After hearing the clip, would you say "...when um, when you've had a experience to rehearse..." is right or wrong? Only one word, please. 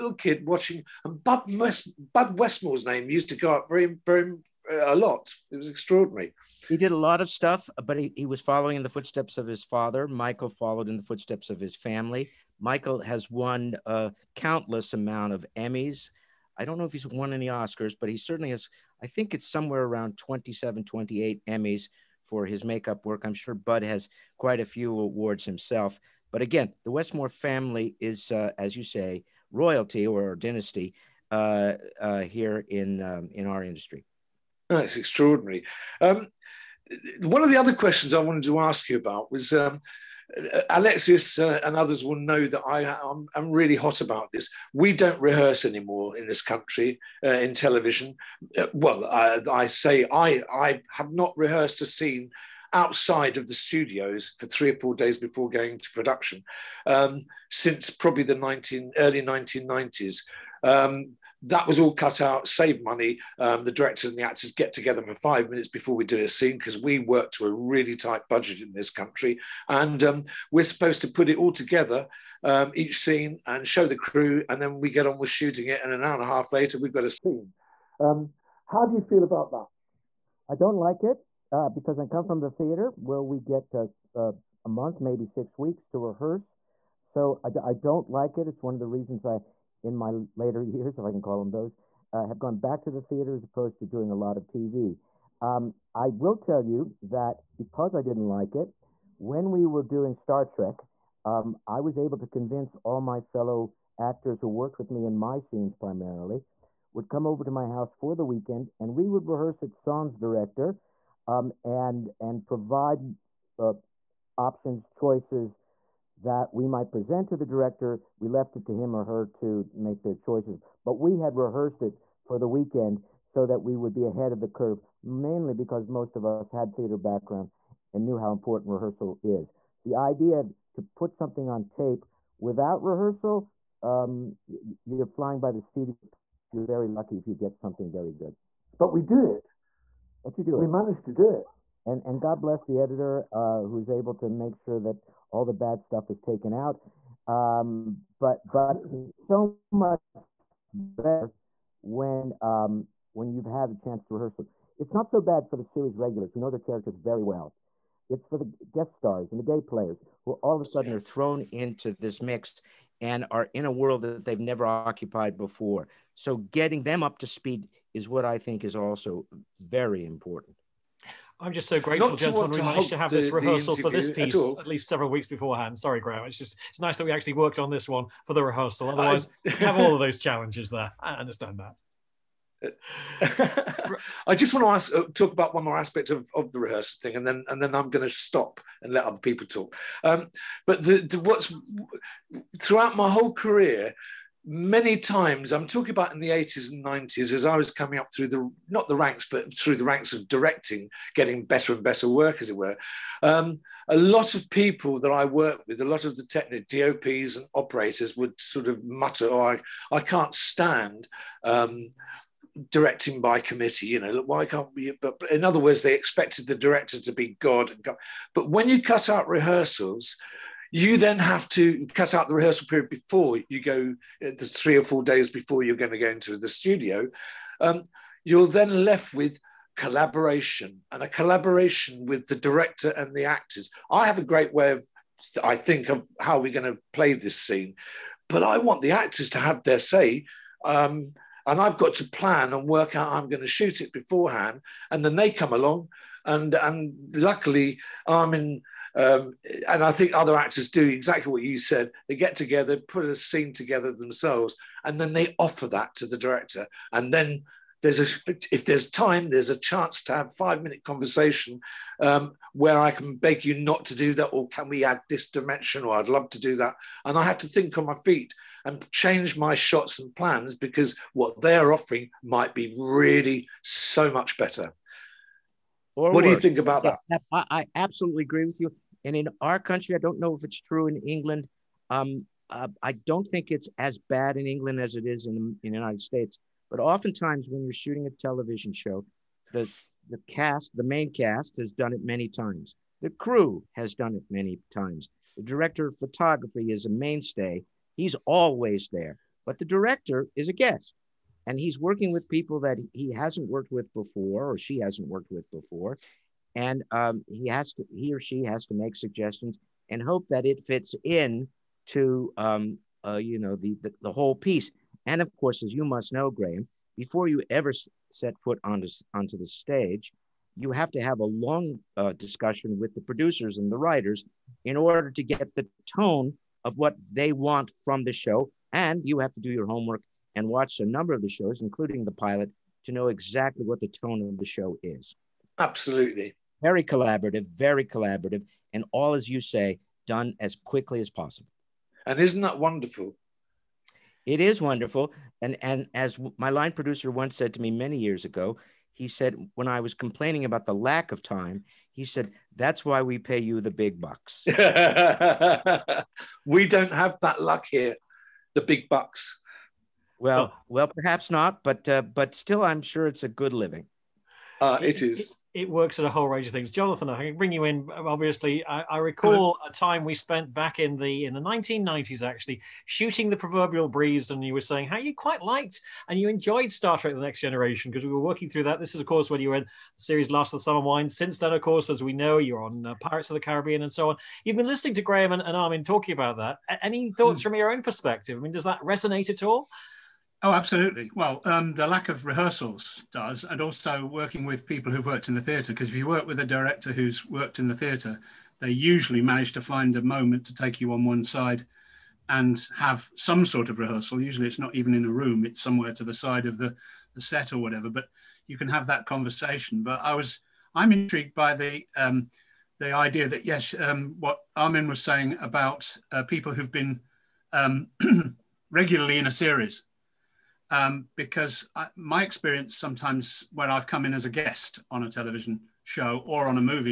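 wrong.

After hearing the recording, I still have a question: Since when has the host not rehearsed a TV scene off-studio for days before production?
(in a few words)
early 1990s.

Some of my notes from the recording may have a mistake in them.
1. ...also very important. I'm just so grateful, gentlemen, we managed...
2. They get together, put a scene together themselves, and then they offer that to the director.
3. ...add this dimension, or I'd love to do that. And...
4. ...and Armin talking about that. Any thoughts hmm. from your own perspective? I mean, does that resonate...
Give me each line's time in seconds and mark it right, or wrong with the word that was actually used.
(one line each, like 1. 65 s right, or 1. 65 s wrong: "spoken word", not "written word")
1. 168 s right
2. 252 s right
3. 264 s right
4. 385 s right.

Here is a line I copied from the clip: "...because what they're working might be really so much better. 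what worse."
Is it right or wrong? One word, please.
wrong.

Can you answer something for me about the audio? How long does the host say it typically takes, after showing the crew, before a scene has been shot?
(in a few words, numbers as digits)
an hour and a half.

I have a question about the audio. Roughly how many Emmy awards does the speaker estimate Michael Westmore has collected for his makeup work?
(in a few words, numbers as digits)
27 or 28.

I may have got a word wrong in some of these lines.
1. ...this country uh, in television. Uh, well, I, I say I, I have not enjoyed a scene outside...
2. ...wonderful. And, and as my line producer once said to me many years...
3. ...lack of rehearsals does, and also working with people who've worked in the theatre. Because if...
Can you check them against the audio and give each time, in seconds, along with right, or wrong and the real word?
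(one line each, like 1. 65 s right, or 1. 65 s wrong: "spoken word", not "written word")
1. 46 s wrong: "rehearsed", not "enjoyed"
2. 344 s right
3. 391 s right.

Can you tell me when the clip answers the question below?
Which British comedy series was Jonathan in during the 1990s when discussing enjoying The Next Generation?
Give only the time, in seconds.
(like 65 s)
380 s.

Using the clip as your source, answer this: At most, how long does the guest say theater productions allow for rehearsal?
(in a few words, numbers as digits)
6 weeks.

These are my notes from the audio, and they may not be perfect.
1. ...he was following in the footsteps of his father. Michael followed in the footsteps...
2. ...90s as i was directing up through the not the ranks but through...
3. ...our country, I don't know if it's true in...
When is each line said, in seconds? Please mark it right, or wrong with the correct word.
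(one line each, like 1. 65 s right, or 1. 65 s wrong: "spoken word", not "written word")
1. 8 s right
2. 196 s wrong: "coming", not "directing"
3. 279 s right.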